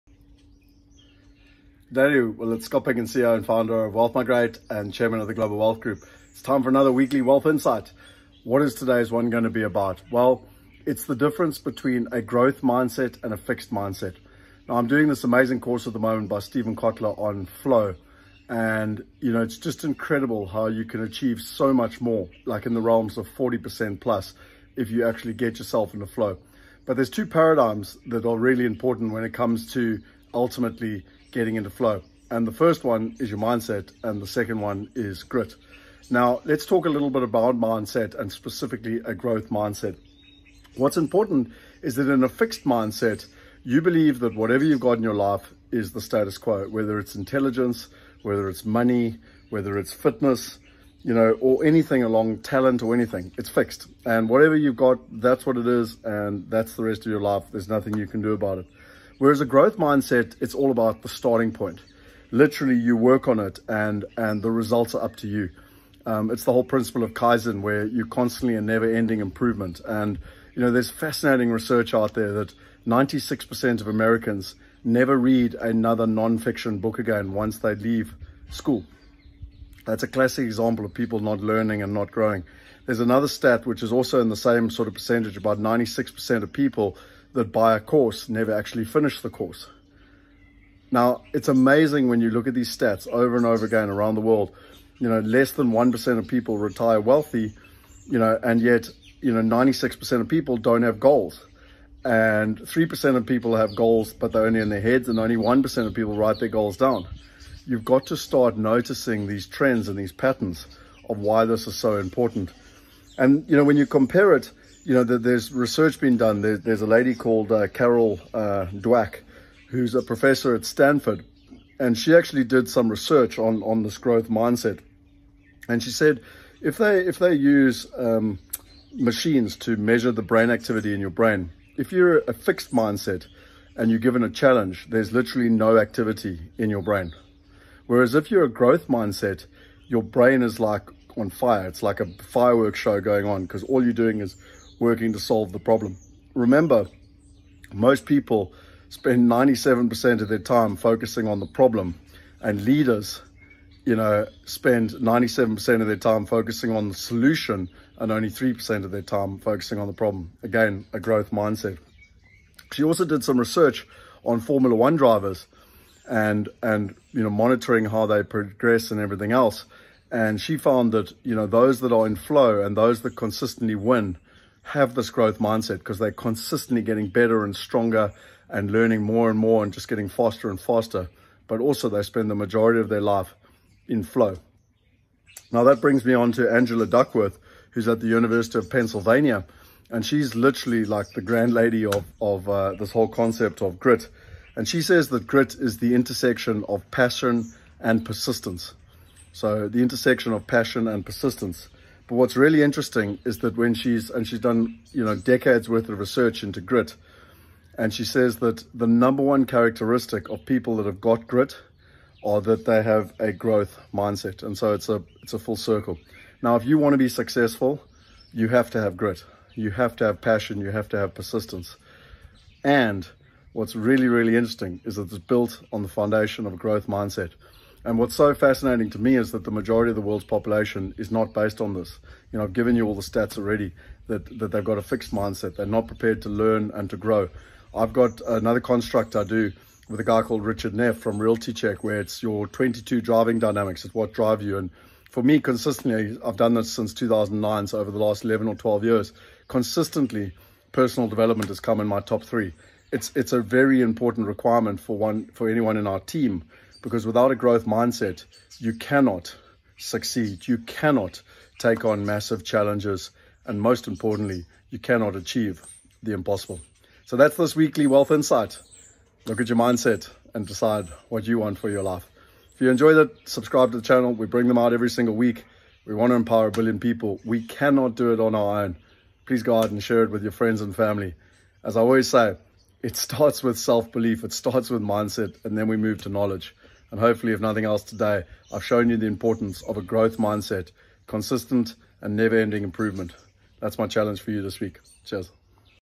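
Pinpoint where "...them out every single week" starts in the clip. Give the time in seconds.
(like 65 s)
274 s.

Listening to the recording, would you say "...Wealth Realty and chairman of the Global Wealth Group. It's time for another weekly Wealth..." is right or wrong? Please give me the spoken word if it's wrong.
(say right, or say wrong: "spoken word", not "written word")
wrong: "Migrate", not "Realty".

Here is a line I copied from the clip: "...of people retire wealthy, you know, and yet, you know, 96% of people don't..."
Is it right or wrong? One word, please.
right.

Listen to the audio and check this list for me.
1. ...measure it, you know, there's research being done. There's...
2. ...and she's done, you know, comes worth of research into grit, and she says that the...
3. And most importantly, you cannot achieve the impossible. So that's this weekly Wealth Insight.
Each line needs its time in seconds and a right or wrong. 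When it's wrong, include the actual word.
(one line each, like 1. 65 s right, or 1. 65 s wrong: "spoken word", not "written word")
1. 113 s wrong: "compare", not "measure"
2. 204 s wrong: "decades", not "comes"
3. 263 s right.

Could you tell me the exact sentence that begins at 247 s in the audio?
So over the last 11 or 12 years, consistently, personal development has come in my top three.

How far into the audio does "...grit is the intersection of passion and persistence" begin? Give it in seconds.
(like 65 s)
195 s.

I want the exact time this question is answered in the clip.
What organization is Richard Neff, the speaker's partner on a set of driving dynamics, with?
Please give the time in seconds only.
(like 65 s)
241 s.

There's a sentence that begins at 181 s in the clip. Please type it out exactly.
But also they spend the majority of their life in flow.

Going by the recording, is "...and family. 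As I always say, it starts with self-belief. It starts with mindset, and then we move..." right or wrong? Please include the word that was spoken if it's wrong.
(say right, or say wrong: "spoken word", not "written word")
right.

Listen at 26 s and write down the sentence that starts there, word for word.
But there's two paradigms that are really important when it comes to ultimately getting into flow.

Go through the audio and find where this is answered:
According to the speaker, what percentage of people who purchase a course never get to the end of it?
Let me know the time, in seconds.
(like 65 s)
85 s.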